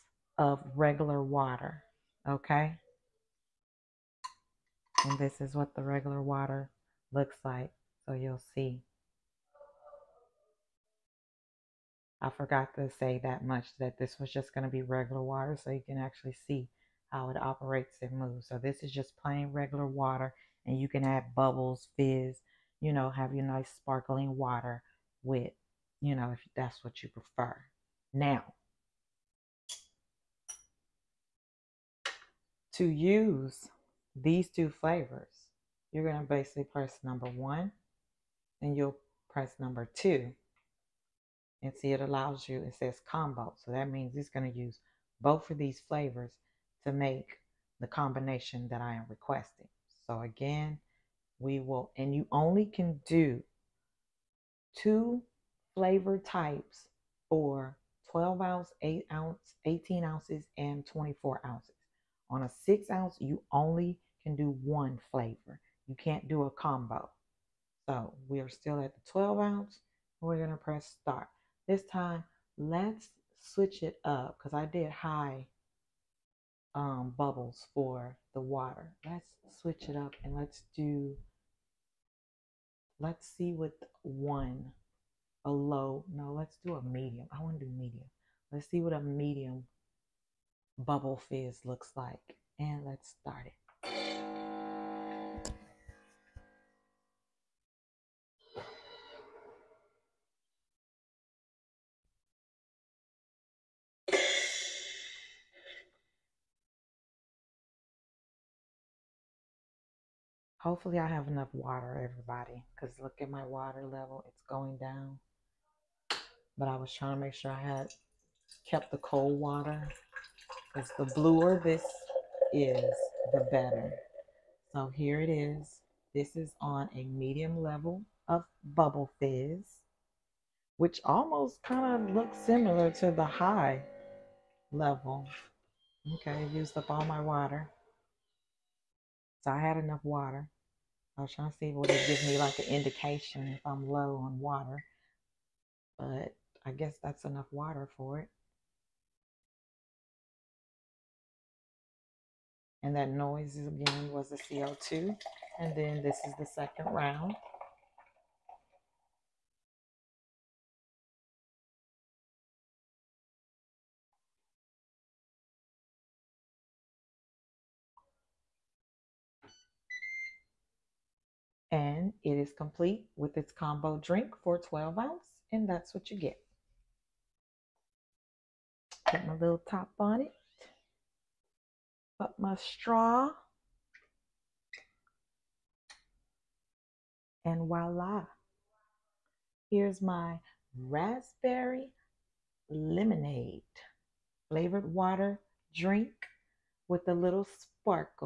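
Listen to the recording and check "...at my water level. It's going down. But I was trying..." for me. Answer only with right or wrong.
right.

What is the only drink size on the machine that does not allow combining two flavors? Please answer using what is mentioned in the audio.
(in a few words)
6 ounce.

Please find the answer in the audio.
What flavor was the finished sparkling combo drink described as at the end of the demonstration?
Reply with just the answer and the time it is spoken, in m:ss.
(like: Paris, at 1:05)
raspberry lemonade, at 3:10.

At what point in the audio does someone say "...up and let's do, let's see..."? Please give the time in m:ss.
1:19.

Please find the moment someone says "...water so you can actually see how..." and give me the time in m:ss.
0:15.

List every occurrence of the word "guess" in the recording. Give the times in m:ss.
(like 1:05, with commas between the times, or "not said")
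2:26.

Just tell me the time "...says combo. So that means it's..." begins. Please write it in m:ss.
0:42.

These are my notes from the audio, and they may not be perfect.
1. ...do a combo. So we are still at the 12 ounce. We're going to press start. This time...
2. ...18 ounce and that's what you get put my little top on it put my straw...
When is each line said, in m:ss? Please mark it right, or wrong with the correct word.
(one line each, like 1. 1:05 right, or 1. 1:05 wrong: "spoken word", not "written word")
1. 1:06 right
2. 2:54 wrong: "12", not "18".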